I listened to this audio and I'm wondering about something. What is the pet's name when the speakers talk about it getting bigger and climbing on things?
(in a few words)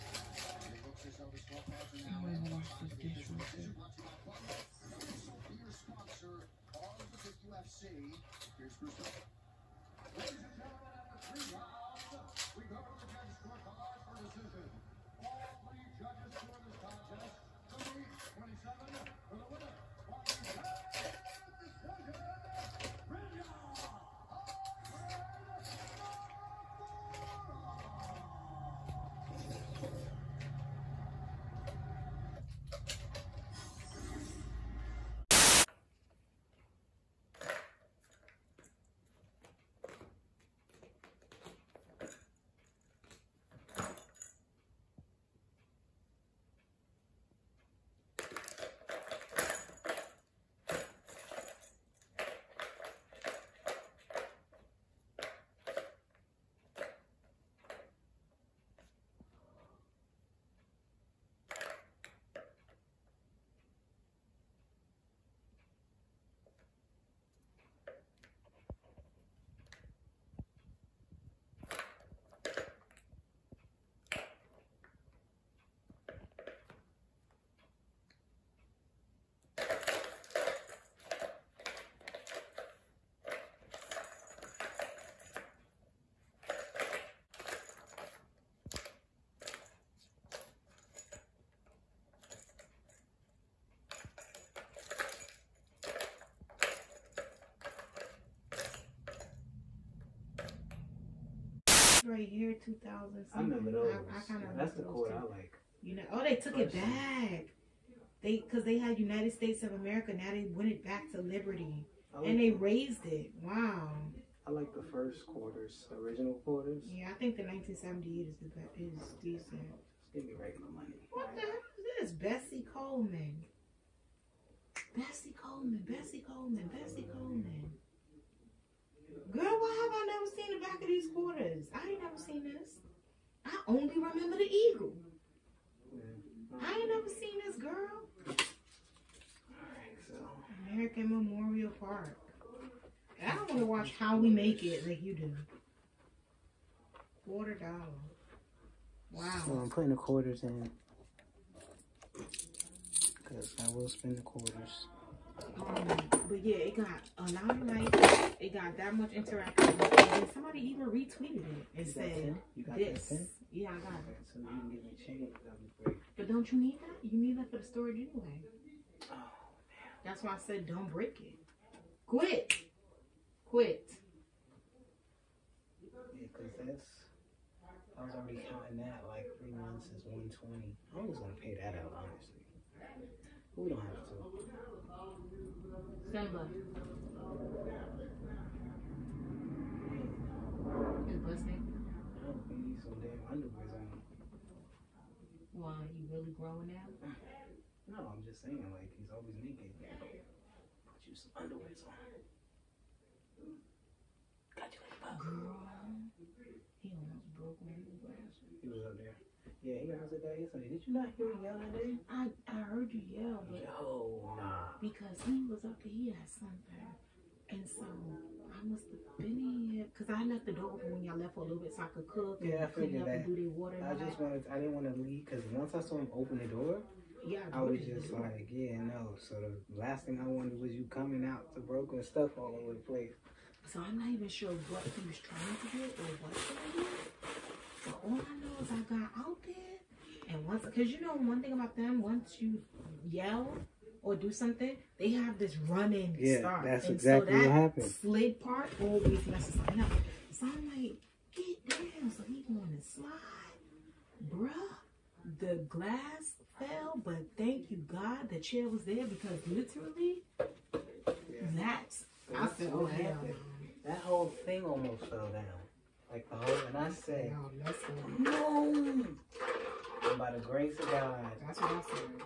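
Simba.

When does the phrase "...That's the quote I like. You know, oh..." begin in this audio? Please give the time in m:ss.
1:44.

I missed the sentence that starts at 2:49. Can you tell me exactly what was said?
Oh, That's why I said don't break it.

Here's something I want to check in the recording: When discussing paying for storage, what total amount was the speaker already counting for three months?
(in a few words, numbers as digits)
120.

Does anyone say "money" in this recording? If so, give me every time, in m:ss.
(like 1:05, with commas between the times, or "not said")
2:00.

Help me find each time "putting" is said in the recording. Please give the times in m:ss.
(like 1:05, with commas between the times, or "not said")
2:29.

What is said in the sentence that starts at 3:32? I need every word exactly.
I, I heard you yell, but Yo, nah.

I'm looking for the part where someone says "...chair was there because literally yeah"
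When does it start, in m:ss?
4:18.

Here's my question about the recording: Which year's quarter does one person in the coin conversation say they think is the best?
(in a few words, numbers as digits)
1978.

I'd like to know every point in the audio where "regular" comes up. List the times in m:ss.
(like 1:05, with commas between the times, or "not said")
2:00.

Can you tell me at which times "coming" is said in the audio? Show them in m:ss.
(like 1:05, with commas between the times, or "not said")
3:50.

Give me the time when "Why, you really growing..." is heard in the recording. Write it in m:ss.
3:15.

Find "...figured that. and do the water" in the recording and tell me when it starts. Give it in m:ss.
3:42.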